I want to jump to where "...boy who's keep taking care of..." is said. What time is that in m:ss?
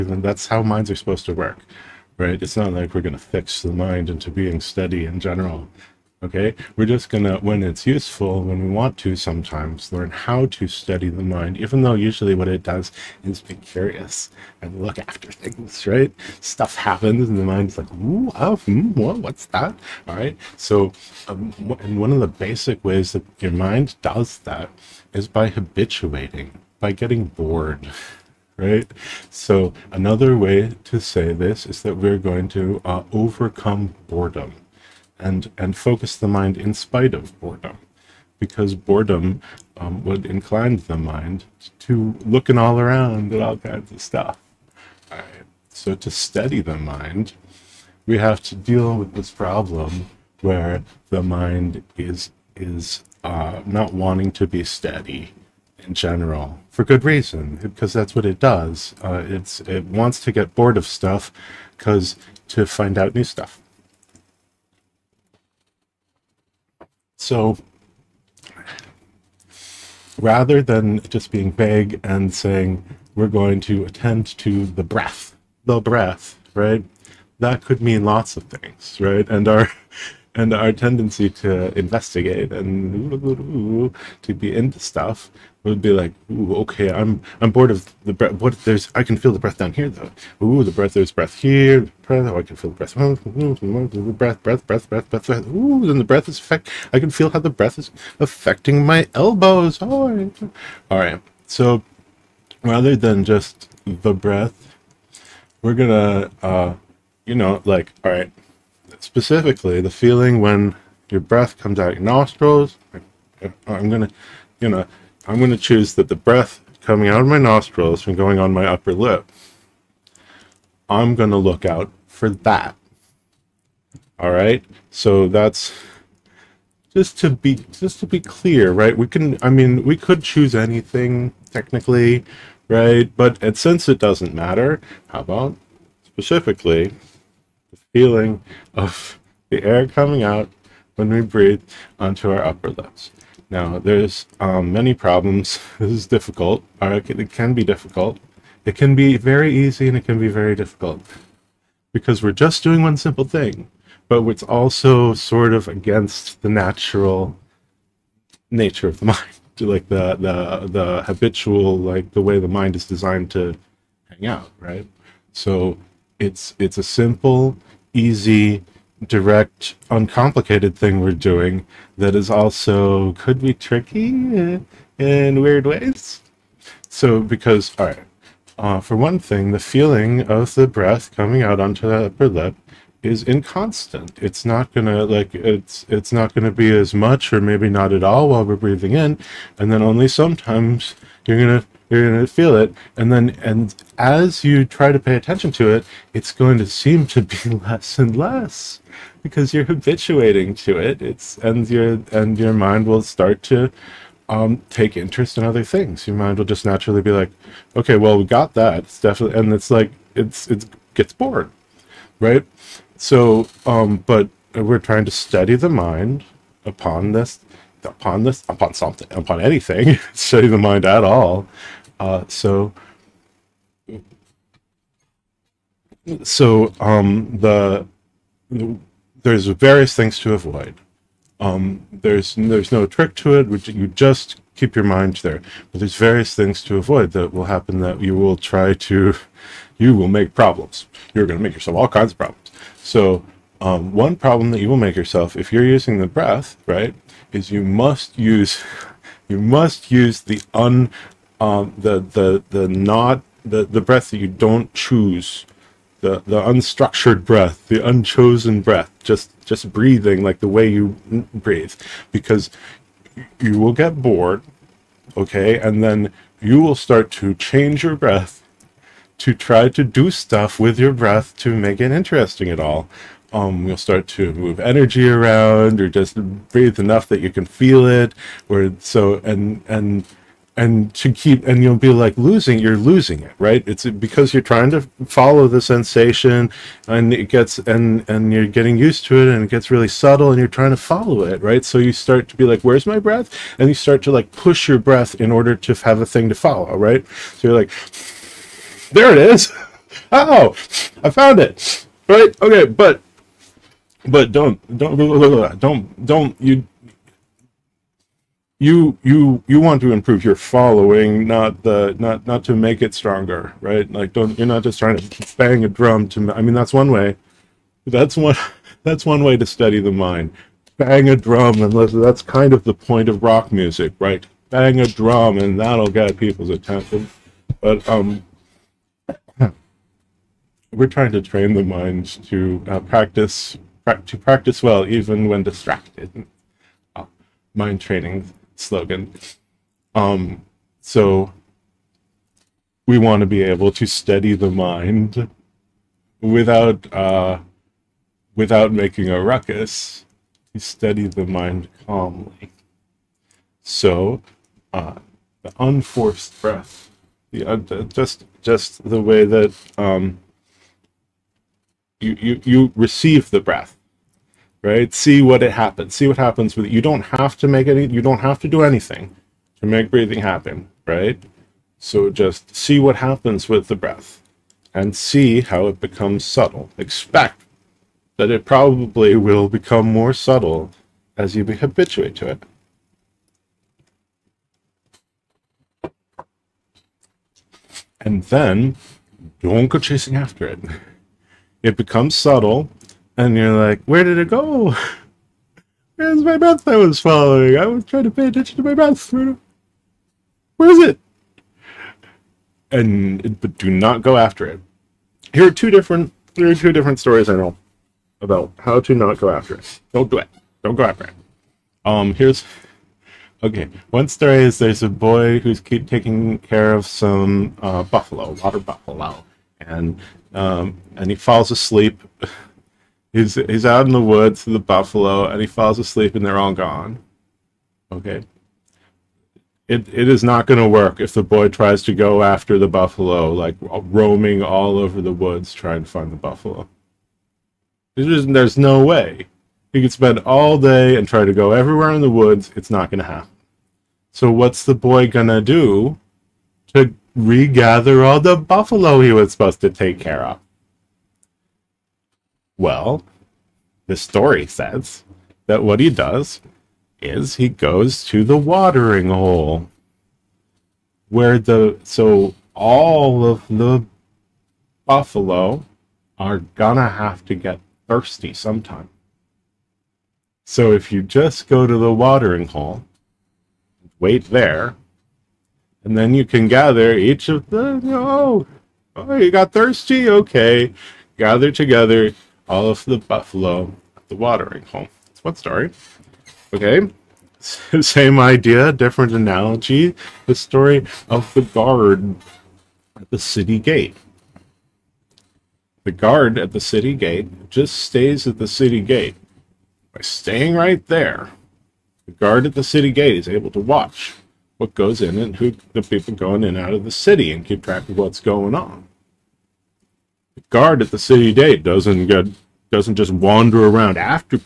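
6:54.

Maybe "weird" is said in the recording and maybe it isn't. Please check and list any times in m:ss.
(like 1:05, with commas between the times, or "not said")
2:55.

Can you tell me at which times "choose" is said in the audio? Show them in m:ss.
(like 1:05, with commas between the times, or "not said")
1:55, 2:10, 4:14.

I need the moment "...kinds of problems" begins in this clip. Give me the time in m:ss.
4:01.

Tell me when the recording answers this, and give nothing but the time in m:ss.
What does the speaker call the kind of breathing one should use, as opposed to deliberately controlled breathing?
4:17.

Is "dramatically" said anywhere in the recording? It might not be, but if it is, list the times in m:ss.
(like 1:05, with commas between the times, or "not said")
not said.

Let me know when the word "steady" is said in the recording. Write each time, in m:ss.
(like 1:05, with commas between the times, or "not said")
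0:04, 0:46, 0:54, 5:43, 5:50.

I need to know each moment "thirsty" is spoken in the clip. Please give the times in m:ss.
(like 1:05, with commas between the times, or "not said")
7:47, 7:59.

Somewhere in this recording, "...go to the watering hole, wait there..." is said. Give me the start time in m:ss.
7:51.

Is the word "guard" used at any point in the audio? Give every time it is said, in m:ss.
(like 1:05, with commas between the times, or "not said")
8:11, 8:15, 8:22, 8:30.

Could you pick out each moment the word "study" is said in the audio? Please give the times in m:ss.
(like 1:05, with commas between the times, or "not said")
0:10, 3:35, 3:40, 5:19.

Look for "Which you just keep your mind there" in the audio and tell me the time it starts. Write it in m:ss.
3:53.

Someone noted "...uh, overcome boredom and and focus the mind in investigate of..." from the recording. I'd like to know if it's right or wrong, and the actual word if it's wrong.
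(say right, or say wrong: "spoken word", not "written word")
wrong: "spite", not "investigate".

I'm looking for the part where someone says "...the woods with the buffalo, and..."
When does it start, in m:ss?
7:03.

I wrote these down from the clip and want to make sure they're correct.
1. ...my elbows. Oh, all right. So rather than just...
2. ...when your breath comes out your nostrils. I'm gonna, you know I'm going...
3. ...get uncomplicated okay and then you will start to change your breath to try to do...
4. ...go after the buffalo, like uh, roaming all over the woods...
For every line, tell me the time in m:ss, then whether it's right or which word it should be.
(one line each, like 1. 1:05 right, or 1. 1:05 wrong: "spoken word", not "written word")
1. 1:38 right
2. 1:50 right
3. 4:23 wrong: "bored", not "uncomplicated"
4. 7:11 right.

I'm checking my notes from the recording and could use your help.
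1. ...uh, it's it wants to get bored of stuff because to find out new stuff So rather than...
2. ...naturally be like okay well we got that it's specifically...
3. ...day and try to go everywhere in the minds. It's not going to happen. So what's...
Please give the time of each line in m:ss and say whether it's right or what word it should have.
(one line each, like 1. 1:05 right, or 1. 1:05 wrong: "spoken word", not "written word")
1. 0:59 right
2. 3:26 wrong: "definitely", not "specifically"
3. 7:20 wrong: "woods", not "minds".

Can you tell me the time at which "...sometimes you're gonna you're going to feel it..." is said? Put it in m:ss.
3:10.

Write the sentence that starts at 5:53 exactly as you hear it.
So uh, the unforced breath, the uh, just just the way that um, you, you, you receive the breath, right?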